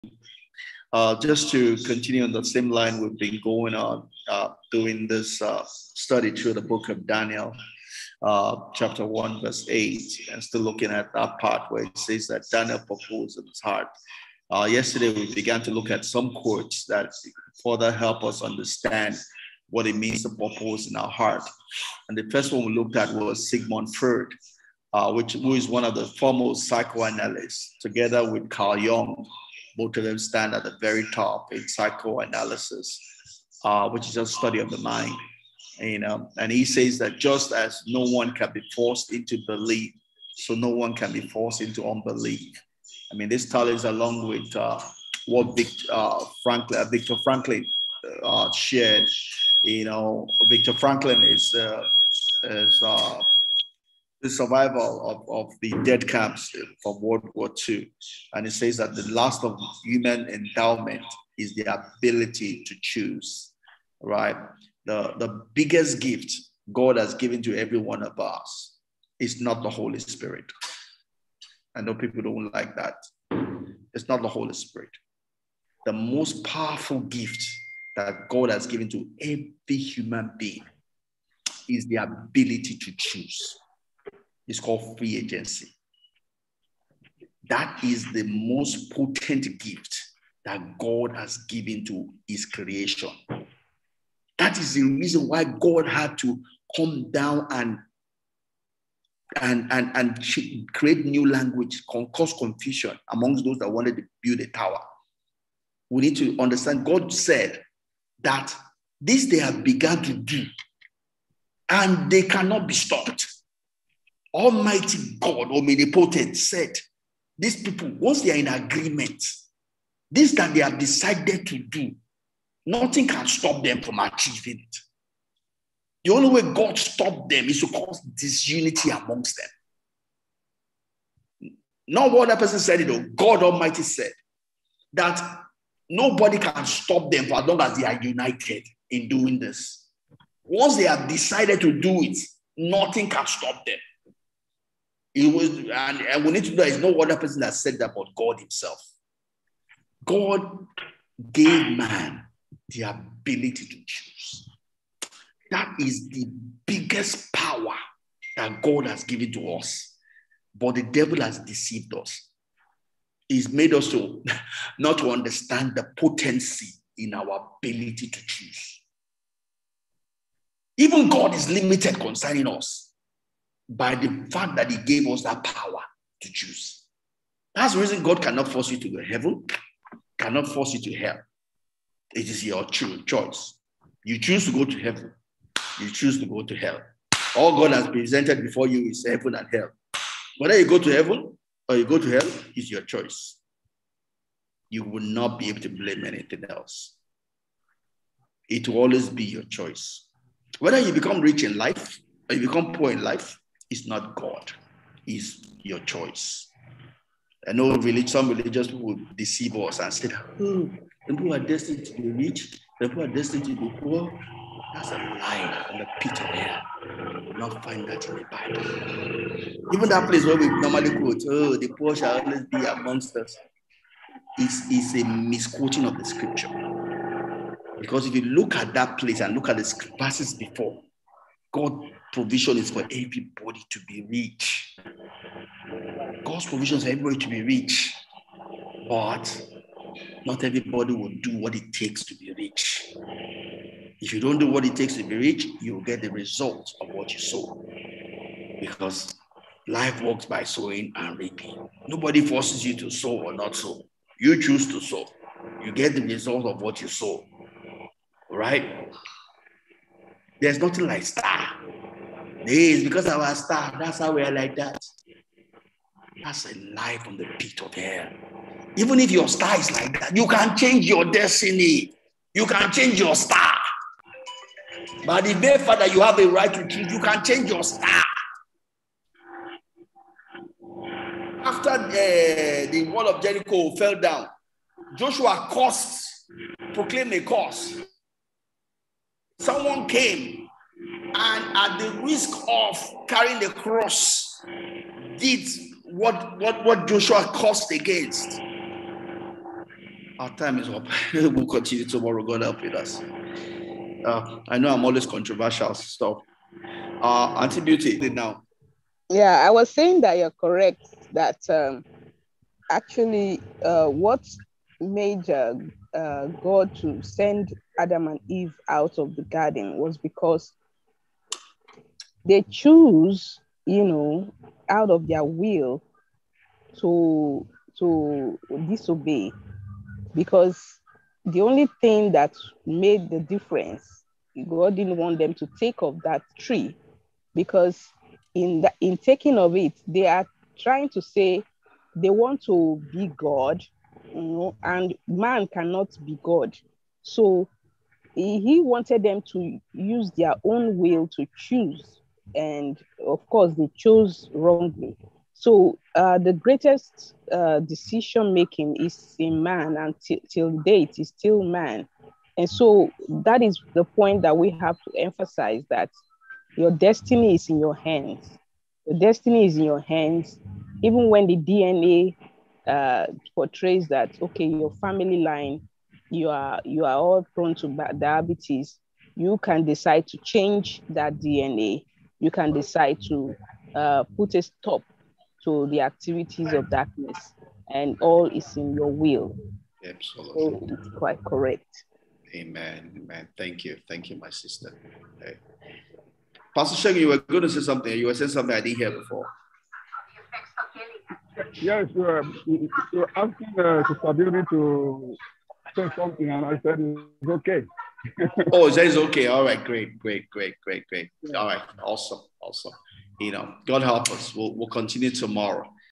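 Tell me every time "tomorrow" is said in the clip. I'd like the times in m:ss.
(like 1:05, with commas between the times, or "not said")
5:01, 6:55.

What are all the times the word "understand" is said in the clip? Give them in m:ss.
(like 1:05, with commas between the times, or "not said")
0:18, 1:46, 2:45.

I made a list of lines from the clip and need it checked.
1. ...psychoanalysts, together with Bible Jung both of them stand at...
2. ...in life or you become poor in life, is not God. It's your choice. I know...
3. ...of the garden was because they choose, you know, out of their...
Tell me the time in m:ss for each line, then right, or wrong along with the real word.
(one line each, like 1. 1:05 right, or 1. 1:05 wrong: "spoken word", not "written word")
1. 0:26 wrong: "Carl", not "Bible"
2. 3:21 right
3. 5:18 right.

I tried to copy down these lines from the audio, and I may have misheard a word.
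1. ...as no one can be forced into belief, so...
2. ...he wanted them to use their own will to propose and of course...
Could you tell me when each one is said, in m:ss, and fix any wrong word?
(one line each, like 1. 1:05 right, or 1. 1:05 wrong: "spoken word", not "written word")
1. 0:37 right
2. 5:48 wrong: "choose", not "propose".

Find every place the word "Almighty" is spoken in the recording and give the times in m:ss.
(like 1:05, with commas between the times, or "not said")
1:54, 2:13.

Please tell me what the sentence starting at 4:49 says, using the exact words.
Someone came and at the risk of carrying the cross, did what, what, what Joshua cursed against.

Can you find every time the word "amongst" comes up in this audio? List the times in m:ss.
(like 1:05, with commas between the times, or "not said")
1:43, 2:08, 3:42.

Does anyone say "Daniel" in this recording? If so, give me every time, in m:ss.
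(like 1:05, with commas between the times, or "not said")
0:07, 0:12.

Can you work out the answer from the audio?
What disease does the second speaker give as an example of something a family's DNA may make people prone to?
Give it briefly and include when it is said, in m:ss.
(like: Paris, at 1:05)
diabetes, at 6:17.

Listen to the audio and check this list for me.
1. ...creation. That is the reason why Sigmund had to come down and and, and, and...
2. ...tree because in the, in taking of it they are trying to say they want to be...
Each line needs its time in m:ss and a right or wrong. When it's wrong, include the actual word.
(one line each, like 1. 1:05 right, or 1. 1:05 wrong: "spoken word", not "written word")
1. 1:32 wrong: "God", not "Sigmund"
2. 5:36 right.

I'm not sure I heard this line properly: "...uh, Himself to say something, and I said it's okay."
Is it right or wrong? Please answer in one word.
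wrong.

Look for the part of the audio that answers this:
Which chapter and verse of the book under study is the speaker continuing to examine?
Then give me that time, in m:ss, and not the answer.
0:08.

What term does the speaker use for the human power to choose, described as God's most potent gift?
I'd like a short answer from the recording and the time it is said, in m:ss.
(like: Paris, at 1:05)
free agency, at 1:24.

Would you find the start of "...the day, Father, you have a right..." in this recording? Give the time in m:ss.
4:35.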